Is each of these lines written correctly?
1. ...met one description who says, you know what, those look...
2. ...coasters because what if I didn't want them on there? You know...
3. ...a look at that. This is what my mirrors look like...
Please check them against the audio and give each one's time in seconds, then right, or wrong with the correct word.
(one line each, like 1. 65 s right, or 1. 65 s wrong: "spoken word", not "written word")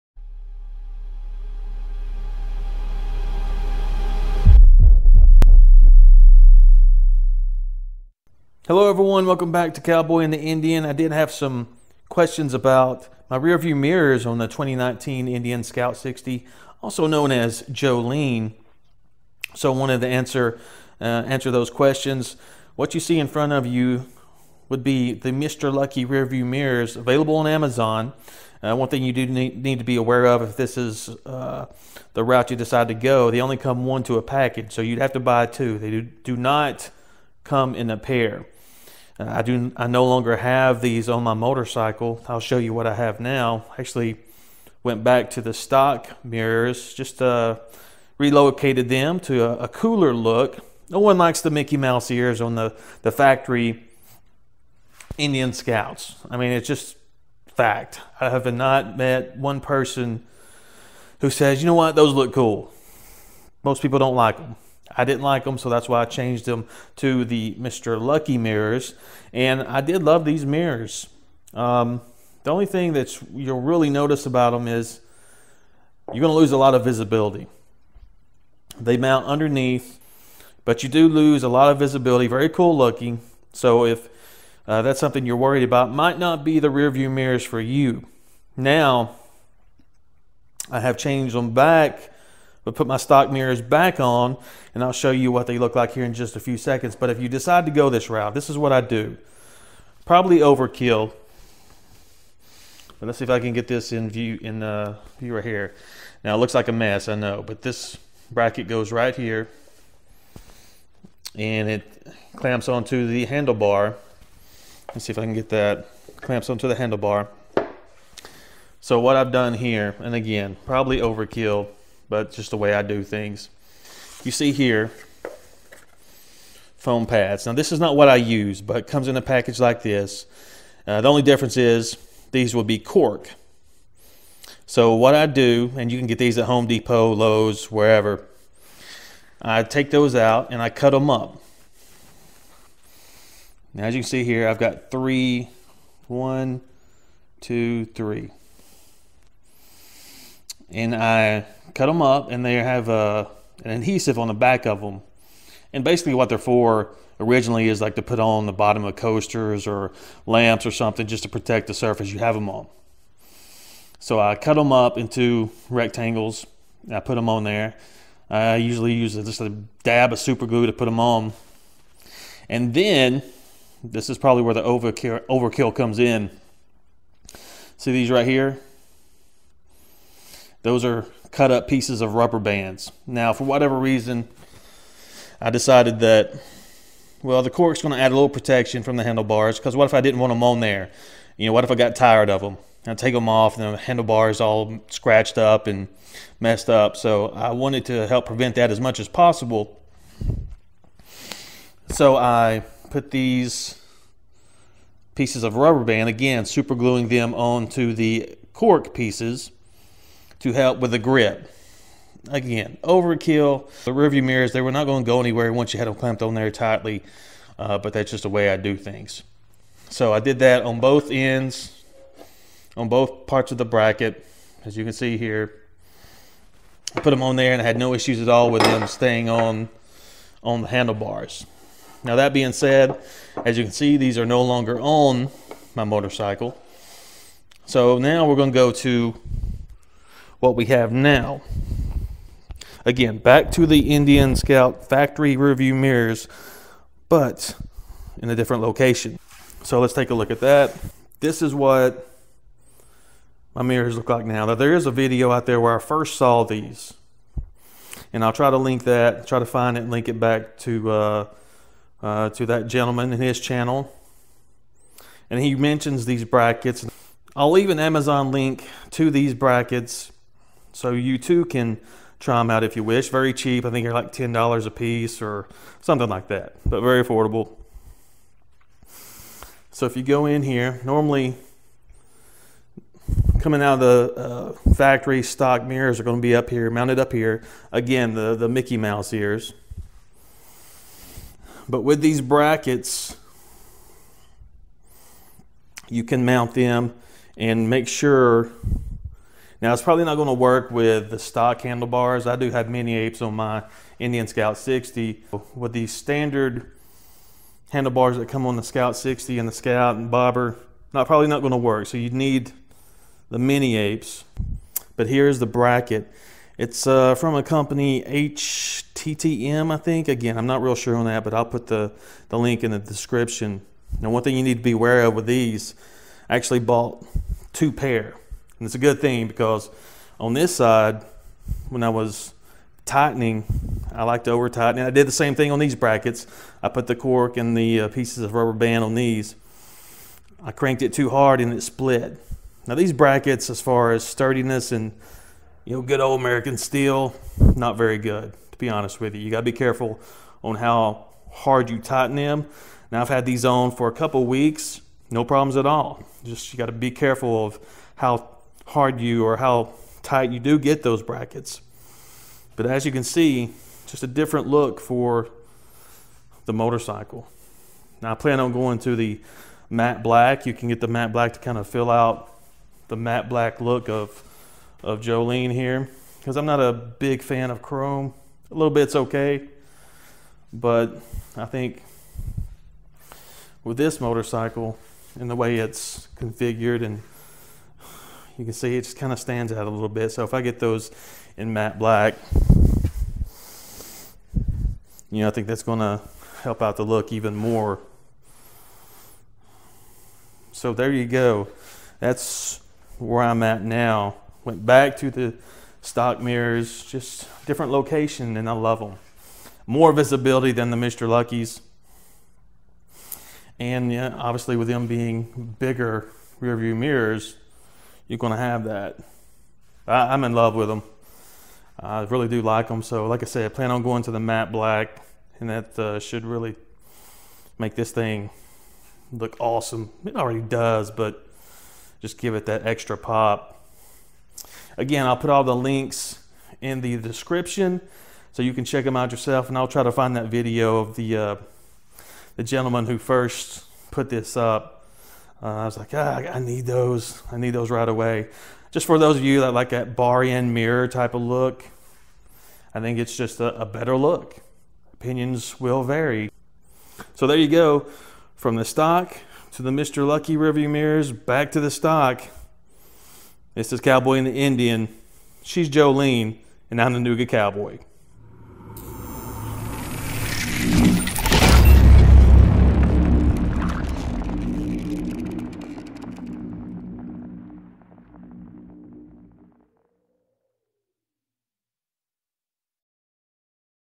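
1. 58 s wrong: "person", not "description"
2. 189 s wrong: "handlebars", not "coasters"
3. 250 s right.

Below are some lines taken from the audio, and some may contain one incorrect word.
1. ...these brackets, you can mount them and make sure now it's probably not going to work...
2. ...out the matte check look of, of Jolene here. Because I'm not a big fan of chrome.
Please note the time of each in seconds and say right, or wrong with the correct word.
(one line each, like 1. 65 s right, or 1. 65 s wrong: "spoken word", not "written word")
1. 292 s right
2. 371 s wrong: "black", not "check".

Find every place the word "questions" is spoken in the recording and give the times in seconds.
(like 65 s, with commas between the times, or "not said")
12 s, 21 s.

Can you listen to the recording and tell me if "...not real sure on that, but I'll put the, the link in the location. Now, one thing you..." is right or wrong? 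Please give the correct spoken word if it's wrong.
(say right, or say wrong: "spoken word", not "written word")
wrong: "description", not "location".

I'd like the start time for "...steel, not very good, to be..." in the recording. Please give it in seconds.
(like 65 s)
346 s.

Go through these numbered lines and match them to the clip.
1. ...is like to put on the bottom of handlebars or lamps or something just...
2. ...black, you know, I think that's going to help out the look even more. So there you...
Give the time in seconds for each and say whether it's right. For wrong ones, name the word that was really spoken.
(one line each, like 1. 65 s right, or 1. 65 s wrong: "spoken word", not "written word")
1. 157 s wrong: "coasters", not "handlebars"
2. 391 s right.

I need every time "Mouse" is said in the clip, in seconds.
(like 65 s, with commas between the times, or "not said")
51 s, 288 s.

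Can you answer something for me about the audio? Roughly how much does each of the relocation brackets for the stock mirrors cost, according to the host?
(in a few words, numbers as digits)
$10.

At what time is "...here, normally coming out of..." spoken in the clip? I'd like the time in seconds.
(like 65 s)
280 s.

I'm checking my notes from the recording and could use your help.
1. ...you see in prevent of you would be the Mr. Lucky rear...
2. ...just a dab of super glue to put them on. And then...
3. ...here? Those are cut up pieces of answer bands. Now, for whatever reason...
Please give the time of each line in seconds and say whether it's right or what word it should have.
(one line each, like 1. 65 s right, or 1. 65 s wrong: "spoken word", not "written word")
1. 22 s wrong: "front", not "prevent"
2. 169 s right
3. 178 s wrong: "rubber", not "answer".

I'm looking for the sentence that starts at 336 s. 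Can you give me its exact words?
I put the cork and the uh, pieces of rubber band on these.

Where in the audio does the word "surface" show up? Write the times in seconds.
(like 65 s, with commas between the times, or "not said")
161 s.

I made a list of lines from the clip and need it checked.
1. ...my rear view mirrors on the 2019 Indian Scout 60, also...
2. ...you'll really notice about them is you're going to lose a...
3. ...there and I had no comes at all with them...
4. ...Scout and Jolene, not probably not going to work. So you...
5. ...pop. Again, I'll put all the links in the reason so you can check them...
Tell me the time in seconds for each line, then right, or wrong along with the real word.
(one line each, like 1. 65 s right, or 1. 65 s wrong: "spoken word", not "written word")
1. 13 s right
2. 73 s right
3. 227 s wrong: "issues", not "comes"
4. 309 s wrong: "Bobber", not "Jolene"
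5. 432 s wrong: "description", not "reason".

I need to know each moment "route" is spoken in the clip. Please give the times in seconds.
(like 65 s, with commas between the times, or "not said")
32 s, 98 s.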